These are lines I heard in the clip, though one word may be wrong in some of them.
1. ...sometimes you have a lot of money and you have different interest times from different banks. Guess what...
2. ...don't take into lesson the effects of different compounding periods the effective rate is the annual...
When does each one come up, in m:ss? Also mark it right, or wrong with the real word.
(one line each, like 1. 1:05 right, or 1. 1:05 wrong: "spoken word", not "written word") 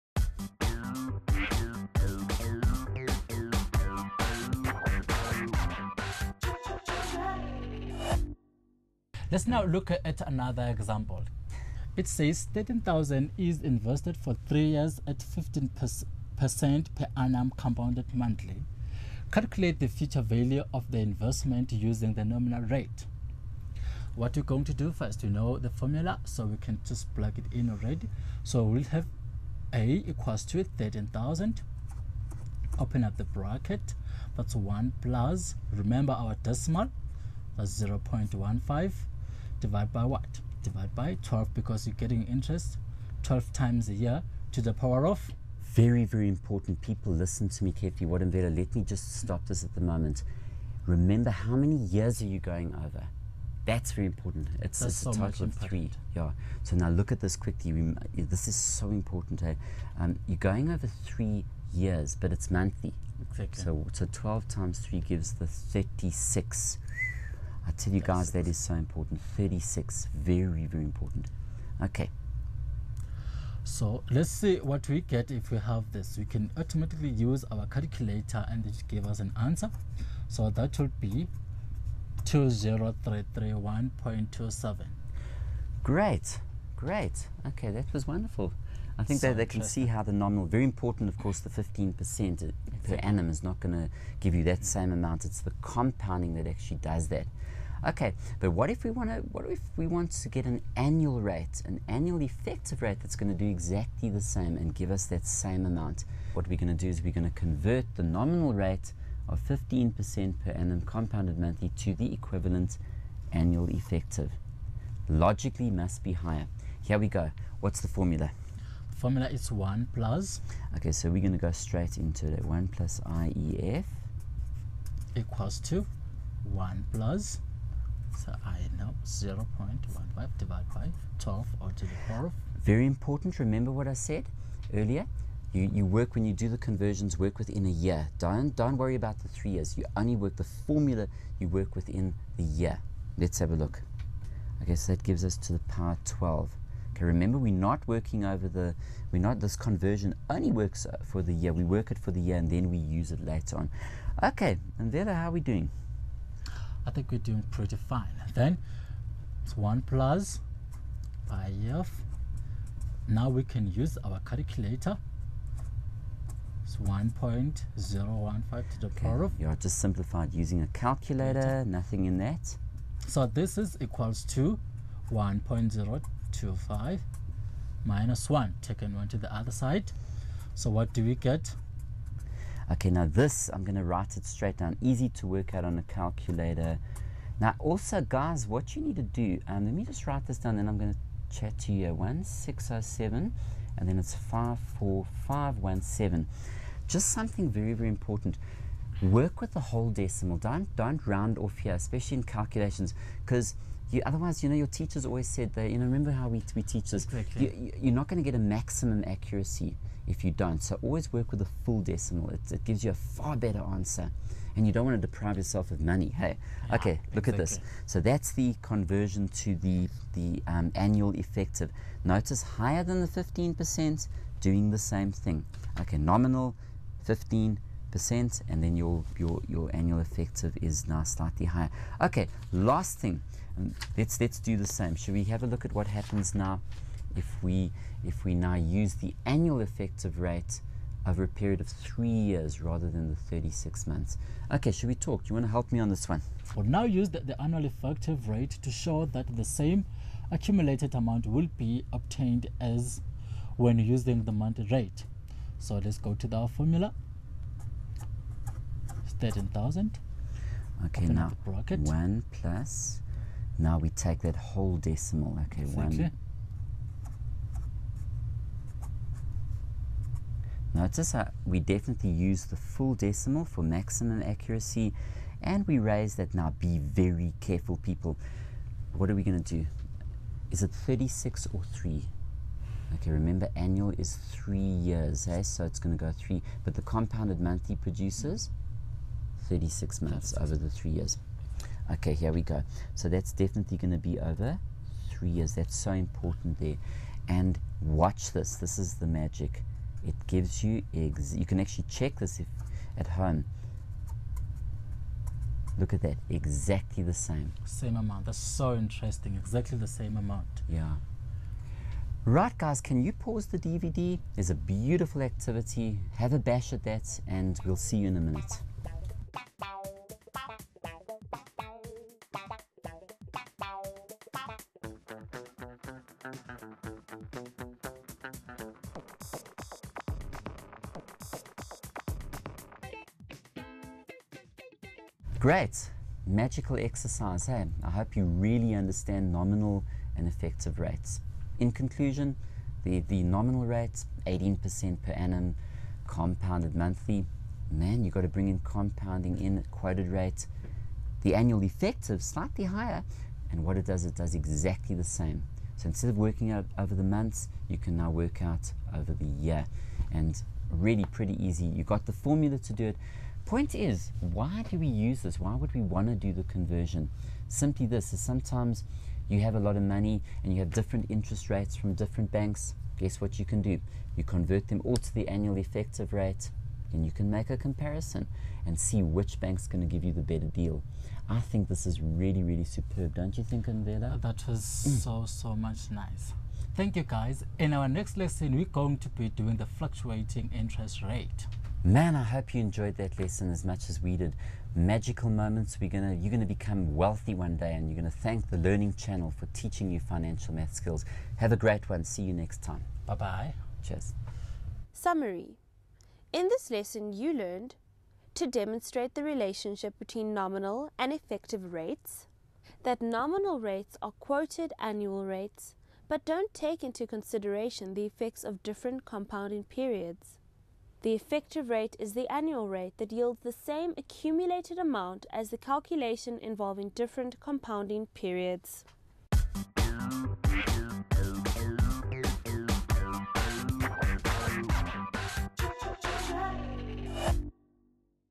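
1. 6:08 wrong: "rates", not "times"
2. 6:56 wrong: "consideration", not "lesson".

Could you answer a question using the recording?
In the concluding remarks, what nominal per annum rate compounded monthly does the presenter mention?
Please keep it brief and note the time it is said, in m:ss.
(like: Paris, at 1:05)
18%, at 5:44.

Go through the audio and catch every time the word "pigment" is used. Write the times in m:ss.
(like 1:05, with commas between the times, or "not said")
not said.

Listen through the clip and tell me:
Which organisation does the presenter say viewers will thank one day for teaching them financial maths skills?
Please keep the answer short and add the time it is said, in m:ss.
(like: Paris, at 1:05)
the Learning Channel, at 6:38.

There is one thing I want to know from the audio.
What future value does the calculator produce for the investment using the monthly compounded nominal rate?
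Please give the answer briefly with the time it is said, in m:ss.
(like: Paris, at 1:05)
20331.27, at 1:22.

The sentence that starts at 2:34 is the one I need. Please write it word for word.
Okay, and there, how are we doing?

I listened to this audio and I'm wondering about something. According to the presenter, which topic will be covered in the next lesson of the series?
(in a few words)
fluctuating interest rate.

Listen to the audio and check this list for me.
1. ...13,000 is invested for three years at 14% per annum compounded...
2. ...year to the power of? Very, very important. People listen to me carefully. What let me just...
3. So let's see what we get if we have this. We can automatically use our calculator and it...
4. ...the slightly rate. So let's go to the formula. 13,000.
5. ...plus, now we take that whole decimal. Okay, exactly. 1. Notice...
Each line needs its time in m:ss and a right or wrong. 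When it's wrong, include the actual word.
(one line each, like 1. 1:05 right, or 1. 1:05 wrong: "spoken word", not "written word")
1. 0:12 wrong: "15", not "14"
2. 0:43 right
3. 1:13 right
4. 4:14 wrong: "monthly", not "slightly"
5. 4:22 right.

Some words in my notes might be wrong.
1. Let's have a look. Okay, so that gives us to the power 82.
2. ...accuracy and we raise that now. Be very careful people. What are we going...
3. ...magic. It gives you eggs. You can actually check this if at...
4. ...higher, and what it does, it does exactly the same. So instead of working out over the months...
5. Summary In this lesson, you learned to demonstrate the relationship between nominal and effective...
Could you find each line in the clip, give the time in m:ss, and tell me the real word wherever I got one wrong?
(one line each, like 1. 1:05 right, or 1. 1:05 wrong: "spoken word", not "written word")
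1. 2:23 wrong: "12", not "82"
2. 4:34 right
3. 4:59 right
4. 5:52 right
5. 6:44 right.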